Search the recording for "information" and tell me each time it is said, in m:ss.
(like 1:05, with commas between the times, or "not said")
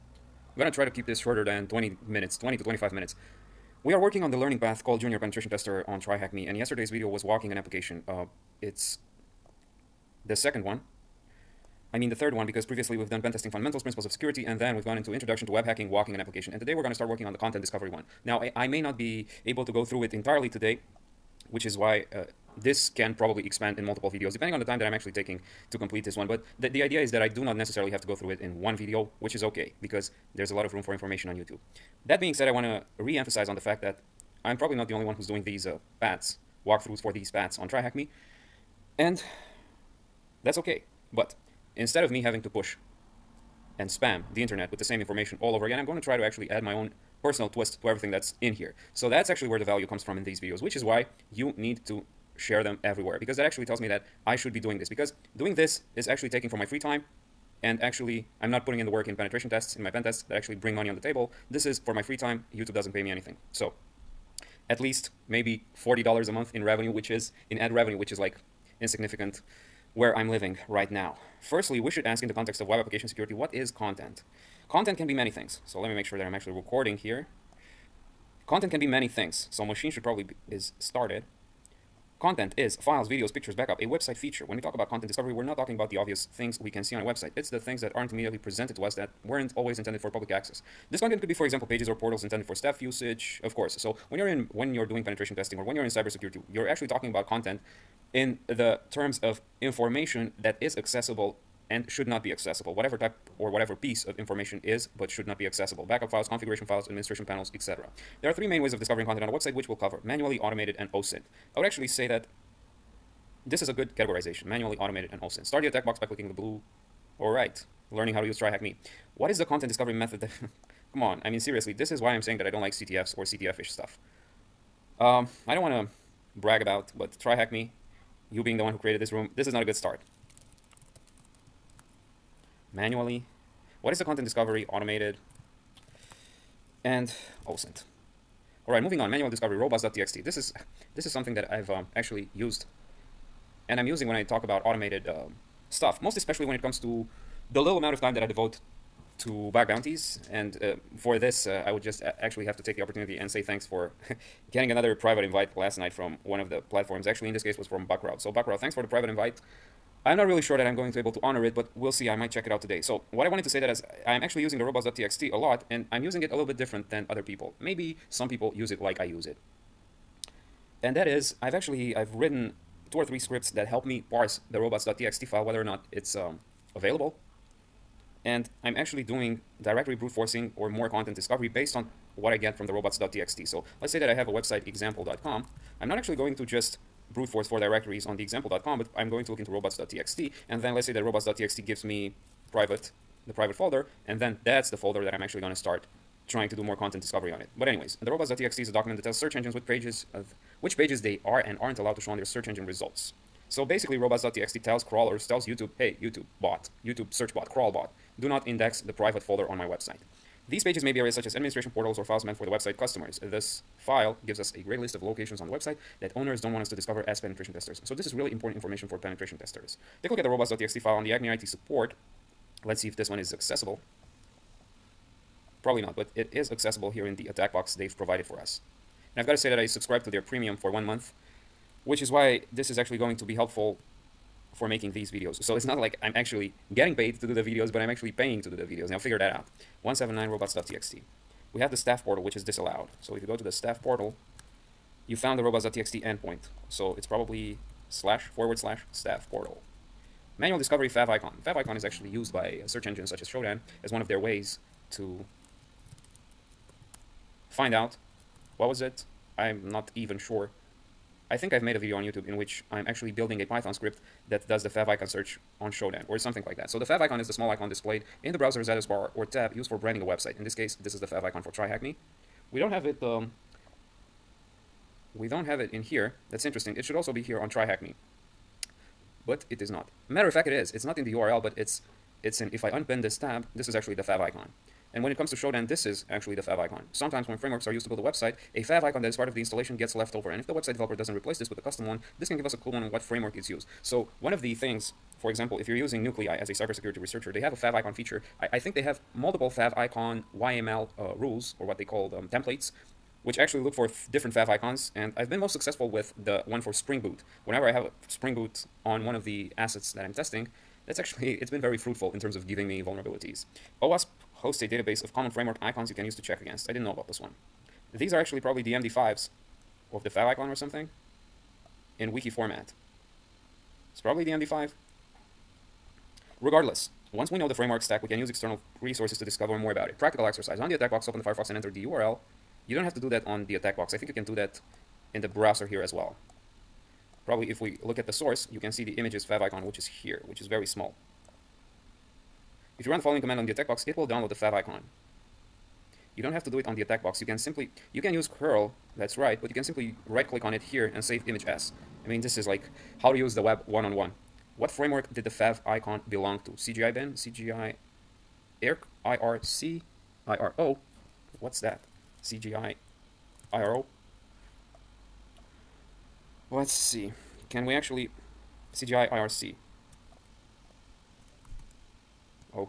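0:30, 0:45, 1:39, 1:44, 3:38.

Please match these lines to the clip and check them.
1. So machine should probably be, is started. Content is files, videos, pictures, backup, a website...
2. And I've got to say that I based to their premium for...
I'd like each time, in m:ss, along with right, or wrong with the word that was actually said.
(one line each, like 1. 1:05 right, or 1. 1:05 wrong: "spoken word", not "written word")
1. 1:19 right
2. 3:49 wrong: "subscribed", not "based".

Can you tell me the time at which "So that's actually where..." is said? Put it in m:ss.
0:48.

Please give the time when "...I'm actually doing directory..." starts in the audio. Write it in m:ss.
2:58.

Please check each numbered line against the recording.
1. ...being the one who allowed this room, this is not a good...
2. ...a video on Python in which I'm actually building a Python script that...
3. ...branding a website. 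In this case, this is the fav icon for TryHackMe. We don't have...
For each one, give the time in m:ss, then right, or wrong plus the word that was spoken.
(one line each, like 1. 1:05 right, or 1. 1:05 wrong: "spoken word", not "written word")
1. 2:08 wrong: "created", not "allowed"
2. 4:21 wrong: "YouTube", not "Python"
3. 4:29 right.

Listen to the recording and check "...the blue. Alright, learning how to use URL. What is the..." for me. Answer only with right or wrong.
wrong.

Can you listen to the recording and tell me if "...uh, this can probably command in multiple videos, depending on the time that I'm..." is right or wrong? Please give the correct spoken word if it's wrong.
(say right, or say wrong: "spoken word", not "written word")
wrong: "expand", not "command".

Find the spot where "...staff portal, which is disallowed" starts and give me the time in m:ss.
4:01.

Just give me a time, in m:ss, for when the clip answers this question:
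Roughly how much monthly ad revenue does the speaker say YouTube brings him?
1:05.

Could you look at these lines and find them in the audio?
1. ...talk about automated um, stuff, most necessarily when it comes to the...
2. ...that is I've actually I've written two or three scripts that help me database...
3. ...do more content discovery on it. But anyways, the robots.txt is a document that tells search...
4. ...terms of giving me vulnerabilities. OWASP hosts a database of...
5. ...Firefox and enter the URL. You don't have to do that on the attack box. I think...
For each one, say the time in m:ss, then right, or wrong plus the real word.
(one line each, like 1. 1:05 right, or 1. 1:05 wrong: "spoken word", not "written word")
1. 2:24 wrong: "especially", not "necessarily"
2. 2:50 wrong: "parse", not "database"
3. 3:16 right
4. 5:12 right
5. 5:31 right.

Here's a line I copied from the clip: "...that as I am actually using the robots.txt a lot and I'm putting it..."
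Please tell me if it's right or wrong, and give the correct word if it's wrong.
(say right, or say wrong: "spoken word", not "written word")
wrong: "using", not "putting".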